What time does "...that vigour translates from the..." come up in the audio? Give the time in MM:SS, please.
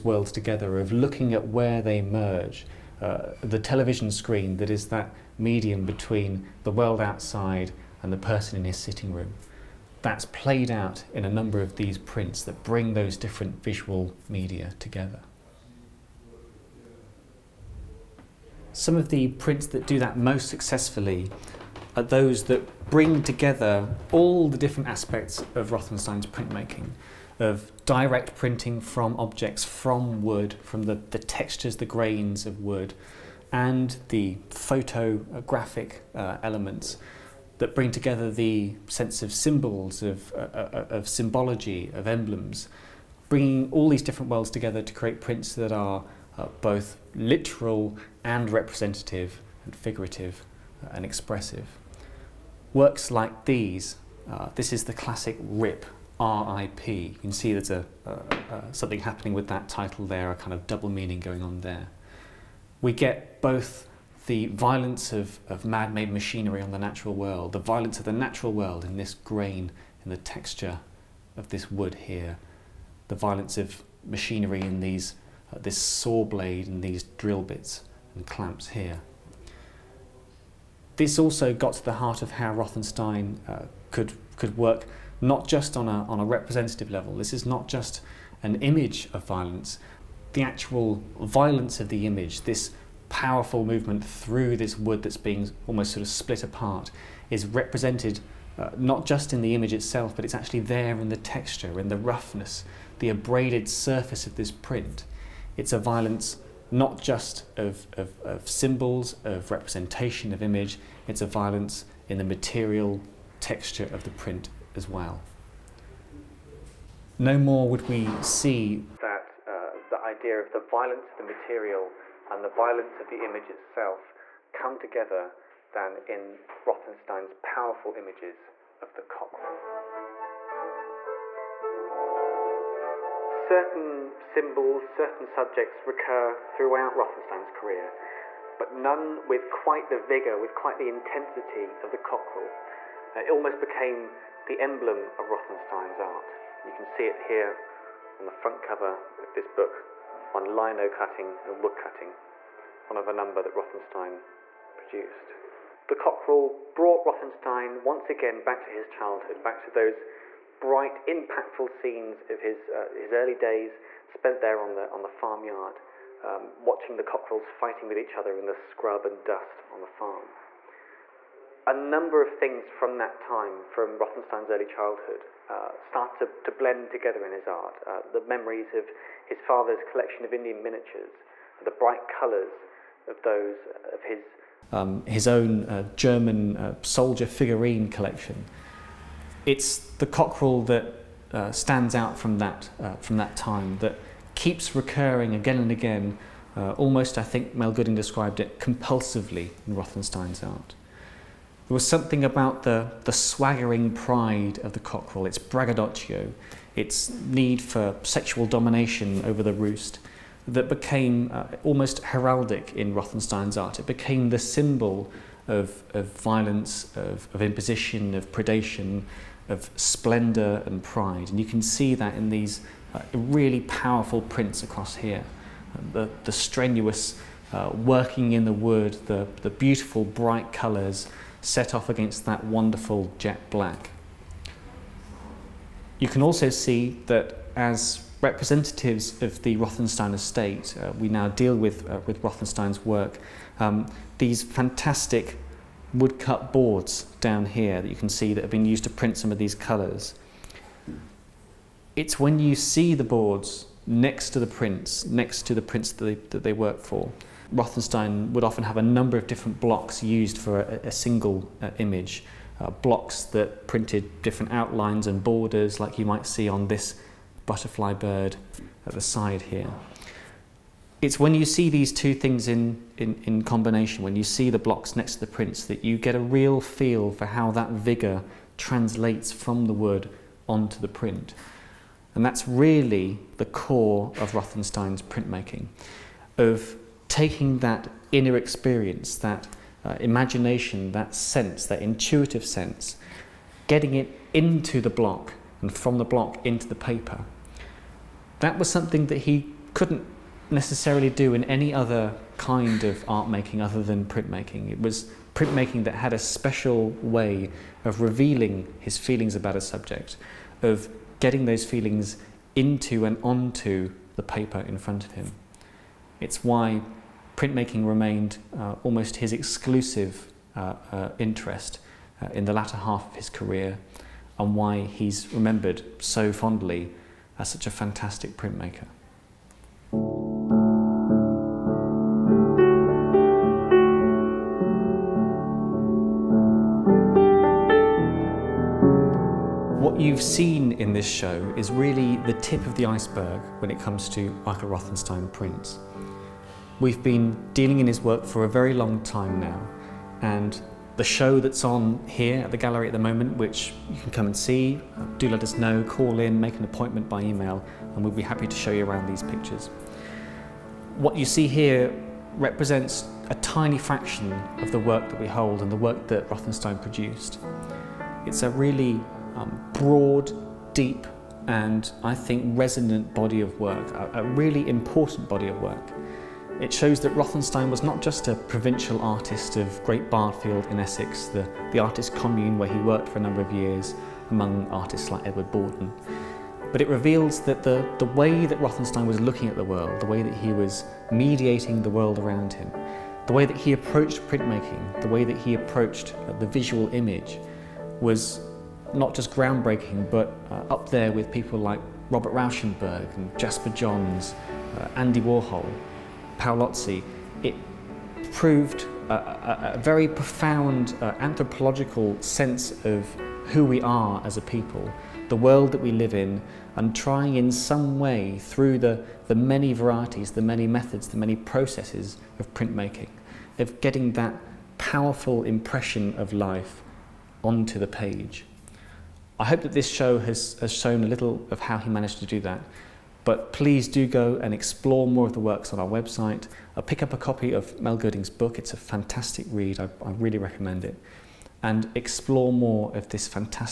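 04:37.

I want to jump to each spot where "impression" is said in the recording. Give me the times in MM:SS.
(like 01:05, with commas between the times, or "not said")
07:05.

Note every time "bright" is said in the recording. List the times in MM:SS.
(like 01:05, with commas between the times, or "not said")
02:40, 03:01, 03:50.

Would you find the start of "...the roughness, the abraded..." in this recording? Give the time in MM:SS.
01:41.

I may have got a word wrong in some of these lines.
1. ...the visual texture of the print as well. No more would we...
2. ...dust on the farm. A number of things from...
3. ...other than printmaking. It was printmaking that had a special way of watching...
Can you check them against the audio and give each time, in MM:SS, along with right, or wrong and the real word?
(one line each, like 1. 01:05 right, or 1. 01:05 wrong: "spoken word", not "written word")
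1. 01:52 wrong: "material", not "visual"
2. 02:49 right
3. 05:03 wrong: "revealing", not "watching".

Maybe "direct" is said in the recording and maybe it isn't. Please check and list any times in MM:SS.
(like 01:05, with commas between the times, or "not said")
00:27.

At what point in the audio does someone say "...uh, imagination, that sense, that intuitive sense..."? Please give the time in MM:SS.
04:49.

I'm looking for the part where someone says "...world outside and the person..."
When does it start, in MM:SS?
00:06.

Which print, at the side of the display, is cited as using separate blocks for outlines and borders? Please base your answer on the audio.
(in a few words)
Butterfly bird.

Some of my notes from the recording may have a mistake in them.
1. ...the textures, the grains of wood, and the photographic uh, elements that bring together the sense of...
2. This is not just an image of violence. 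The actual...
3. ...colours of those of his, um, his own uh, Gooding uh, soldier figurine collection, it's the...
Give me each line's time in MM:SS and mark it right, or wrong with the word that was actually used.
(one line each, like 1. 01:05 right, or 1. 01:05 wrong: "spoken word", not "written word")
1. 00:31 right
2. 01:27 right
3. 03:02 wrong: "German", not "Gooding".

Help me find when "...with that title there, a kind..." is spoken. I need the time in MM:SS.
00:59.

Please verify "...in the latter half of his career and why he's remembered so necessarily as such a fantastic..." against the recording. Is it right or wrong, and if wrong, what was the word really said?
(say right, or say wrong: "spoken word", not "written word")
wrong: "fondly", not "necessarily".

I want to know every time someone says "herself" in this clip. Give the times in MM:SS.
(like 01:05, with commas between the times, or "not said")
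not said.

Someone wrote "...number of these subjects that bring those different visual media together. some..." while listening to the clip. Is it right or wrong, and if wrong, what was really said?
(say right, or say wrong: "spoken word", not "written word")
wrong: "prints", not "subjects".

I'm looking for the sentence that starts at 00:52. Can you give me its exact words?
Works like these, uh, this is the classic RIP, RIP.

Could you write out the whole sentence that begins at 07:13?
But please do go and explore more of the works on our website.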